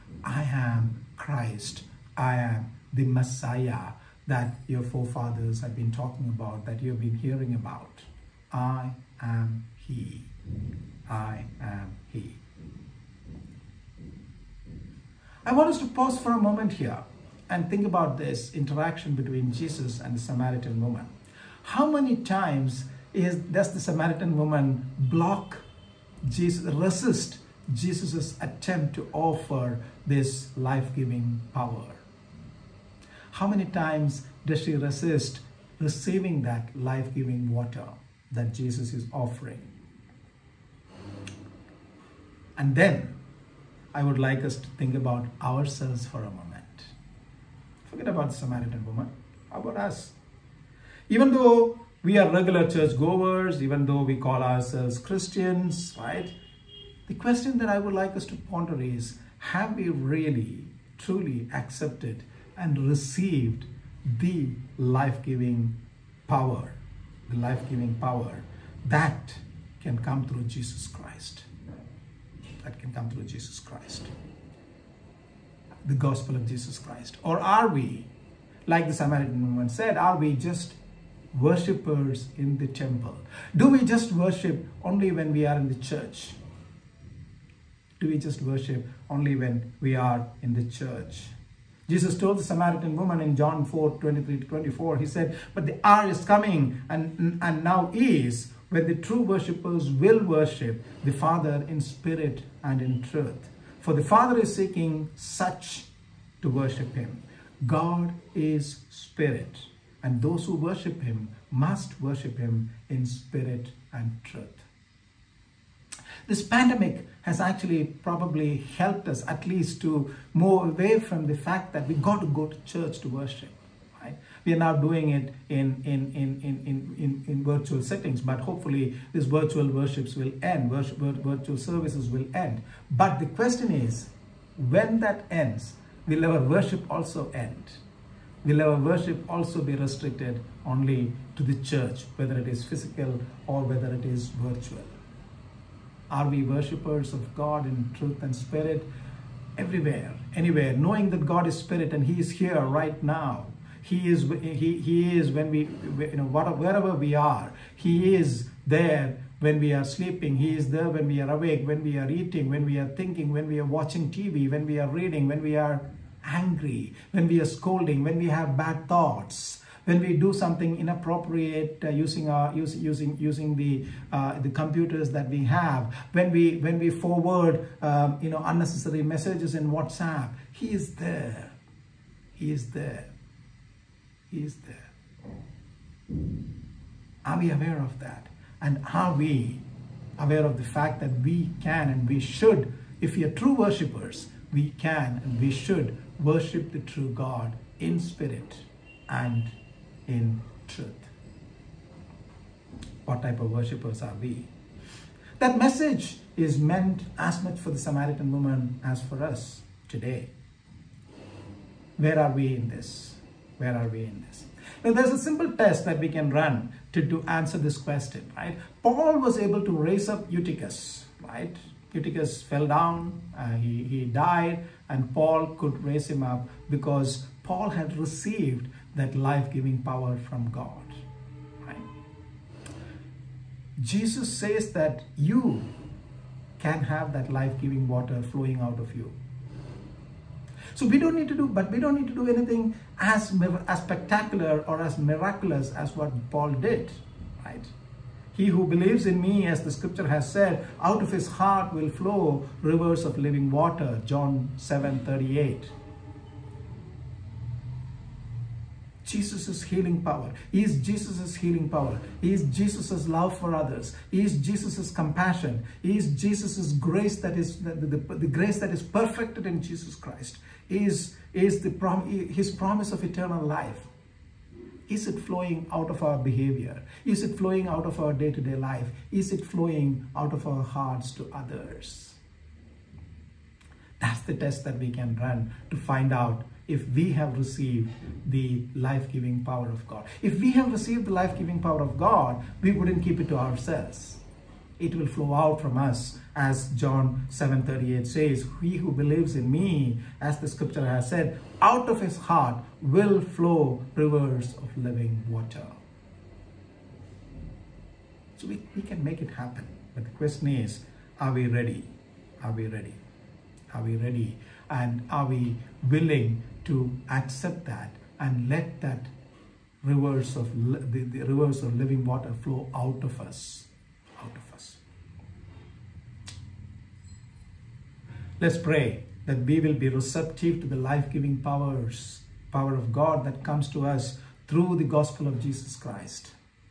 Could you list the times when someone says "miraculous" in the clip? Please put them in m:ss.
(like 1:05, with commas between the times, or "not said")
4:04.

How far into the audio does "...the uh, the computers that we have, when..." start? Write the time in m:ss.
2:53.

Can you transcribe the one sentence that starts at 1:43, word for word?
For the Father is seeking such to worship him.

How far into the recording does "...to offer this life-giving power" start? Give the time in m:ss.
0:28.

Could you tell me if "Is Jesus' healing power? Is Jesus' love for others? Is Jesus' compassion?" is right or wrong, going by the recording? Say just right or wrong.
right.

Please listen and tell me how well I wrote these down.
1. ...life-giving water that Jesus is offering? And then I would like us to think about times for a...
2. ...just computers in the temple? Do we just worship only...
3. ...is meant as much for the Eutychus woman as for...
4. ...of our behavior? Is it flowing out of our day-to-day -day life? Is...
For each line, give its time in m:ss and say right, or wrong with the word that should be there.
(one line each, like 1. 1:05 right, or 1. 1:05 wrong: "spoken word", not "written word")
1. 0:36 wrong: "ourselves", not "times"
2. 1:20 wrong: "worshippers", not "computers"
3. 3:26 wrong: "Samaritan", not "Eutychus"
4. 4:35 right.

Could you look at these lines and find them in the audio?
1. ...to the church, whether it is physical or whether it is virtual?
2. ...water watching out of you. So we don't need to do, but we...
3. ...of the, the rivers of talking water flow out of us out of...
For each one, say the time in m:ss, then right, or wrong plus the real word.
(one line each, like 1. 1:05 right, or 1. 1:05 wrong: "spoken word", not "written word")
1. 2:21 right
2. 3:57 wrong: "flowing", not "watching"
3. 5:20 wrong: "living", not "talking".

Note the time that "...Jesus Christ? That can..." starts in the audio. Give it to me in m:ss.
1:10.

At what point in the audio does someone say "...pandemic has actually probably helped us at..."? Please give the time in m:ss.
1:56.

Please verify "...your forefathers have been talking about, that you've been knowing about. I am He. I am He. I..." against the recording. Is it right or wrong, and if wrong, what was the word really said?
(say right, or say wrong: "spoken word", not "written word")
wrong: "hearing", not "knowing".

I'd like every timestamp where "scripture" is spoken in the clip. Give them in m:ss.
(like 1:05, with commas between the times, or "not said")
4:09, 5:00.